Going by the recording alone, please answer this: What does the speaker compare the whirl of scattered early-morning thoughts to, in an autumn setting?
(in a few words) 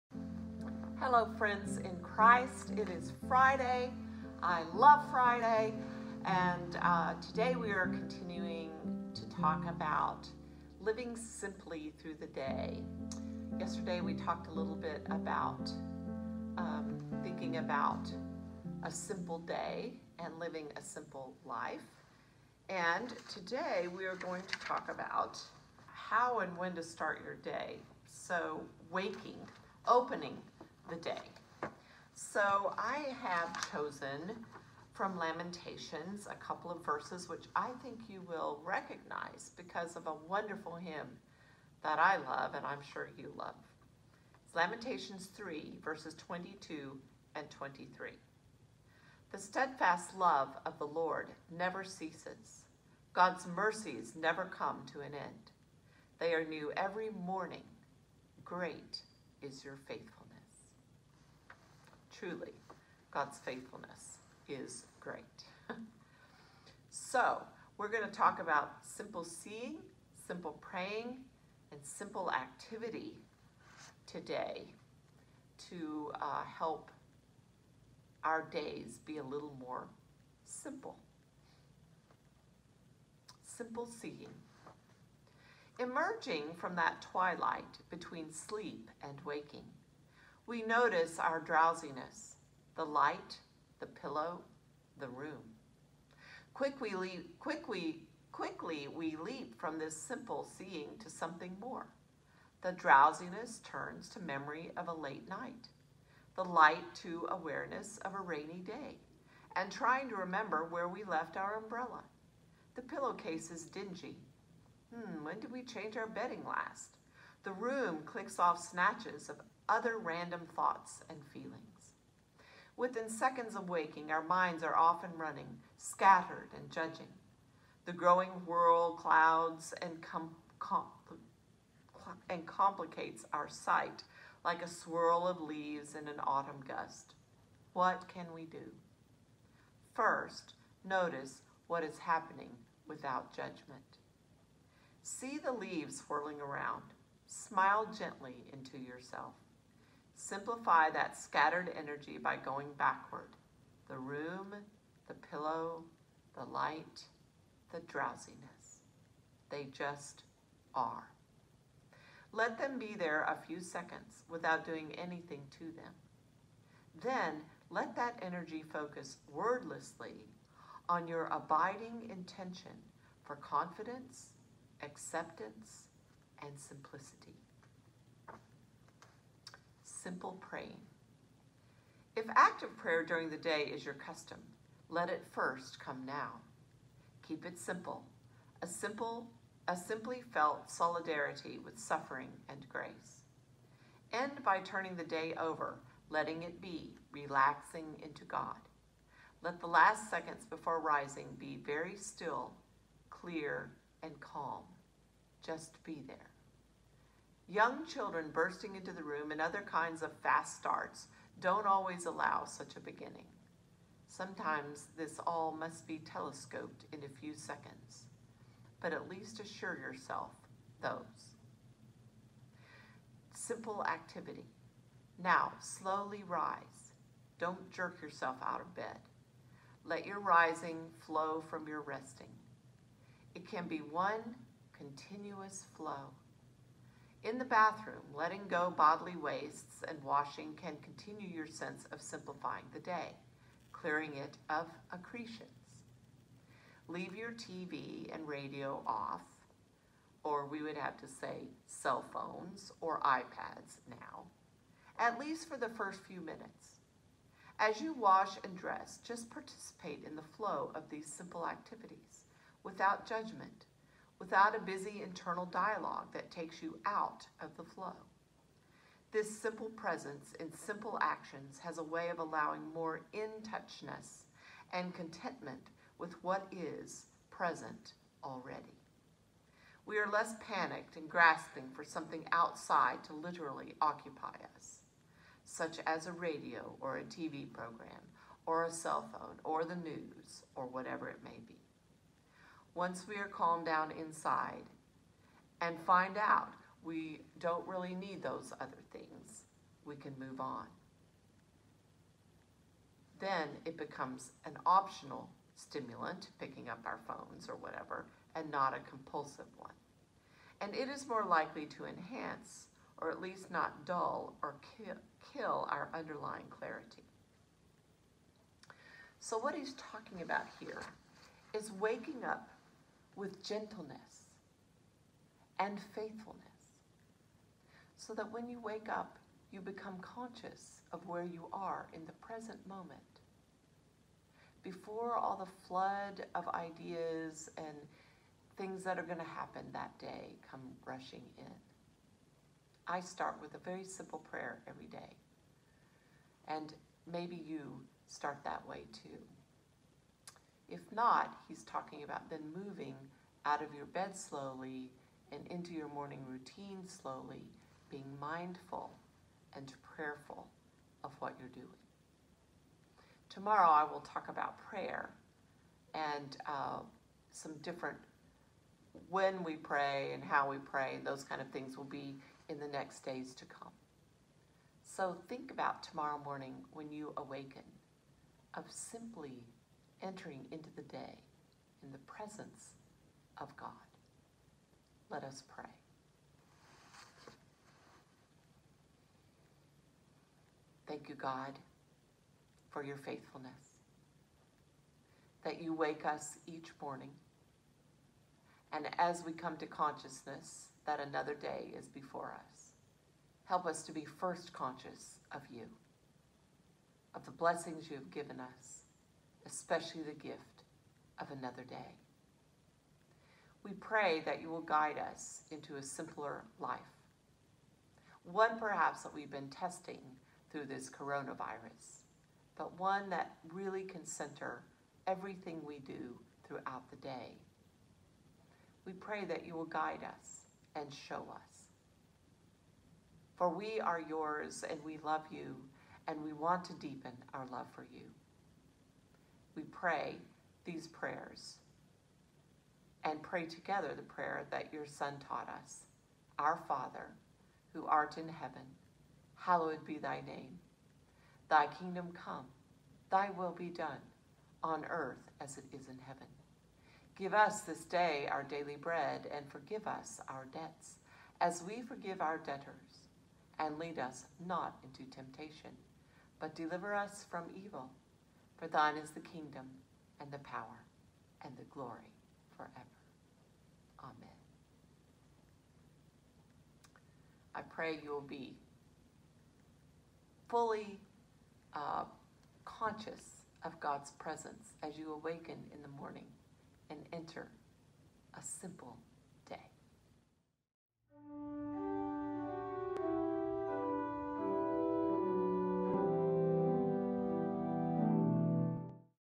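a swirl of leaves.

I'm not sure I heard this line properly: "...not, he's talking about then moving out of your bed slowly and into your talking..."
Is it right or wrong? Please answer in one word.
wrong.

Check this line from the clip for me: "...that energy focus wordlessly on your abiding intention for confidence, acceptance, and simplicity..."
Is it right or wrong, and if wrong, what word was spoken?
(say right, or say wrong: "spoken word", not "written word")
right.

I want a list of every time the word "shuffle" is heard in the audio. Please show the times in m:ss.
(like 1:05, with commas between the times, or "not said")
not said.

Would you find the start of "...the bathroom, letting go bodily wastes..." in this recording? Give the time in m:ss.
3:57.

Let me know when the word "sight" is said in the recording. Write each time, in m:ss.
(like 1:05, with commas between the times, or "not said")
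2:13.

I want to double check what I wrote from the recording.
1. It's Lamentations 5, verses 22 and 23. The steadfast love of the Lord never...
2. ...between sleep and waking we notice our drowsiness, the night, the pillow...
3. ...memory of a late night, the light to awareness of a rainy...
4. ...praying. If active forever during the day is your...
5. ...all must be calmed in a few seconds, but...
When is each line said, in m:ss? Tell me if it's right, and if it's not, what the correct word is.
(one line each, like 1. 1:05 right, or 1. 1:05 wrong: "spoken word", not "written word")
1. 0:44 wrong: "3", not "5"
2. 1:27 wrong: "light", not "night"
3. 1:44 right
4. 3:00 wrong: "prayer", not "forever"
5. 3:35 wrong: "telescoped", not "calmed".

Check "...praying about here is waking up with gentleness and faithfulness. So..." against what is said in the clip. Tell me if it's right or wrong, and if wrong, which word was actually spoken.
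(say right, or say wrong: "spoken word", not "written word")
wrong: "talking", not "praying".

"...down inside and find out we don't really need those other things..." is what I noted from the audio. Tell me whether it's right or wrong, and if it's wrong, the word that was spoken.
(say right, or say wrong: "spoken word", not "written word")
right.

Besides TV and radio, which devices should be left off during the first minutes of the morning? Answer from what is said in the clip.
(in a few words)
cell phones or iPads.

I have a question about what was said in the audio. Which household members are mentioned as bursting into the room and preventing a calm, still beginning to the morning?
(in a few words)
Young children.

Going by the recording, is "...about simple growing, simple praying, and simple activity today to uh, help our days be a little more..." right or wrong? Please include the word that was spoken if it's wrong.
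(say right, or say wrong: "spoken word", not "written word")
wrong: "seeing", not "growing".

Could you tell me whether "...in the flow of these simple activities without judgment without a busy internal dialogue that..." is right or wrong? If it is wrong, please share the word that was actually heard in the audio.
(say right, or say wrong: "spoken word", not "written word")
right.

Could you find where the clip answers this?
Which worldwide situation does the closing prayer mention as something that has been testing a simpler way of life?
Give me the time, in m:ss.
7:00.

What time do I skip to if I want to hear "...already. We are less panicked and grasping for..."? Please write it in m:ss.
4:38.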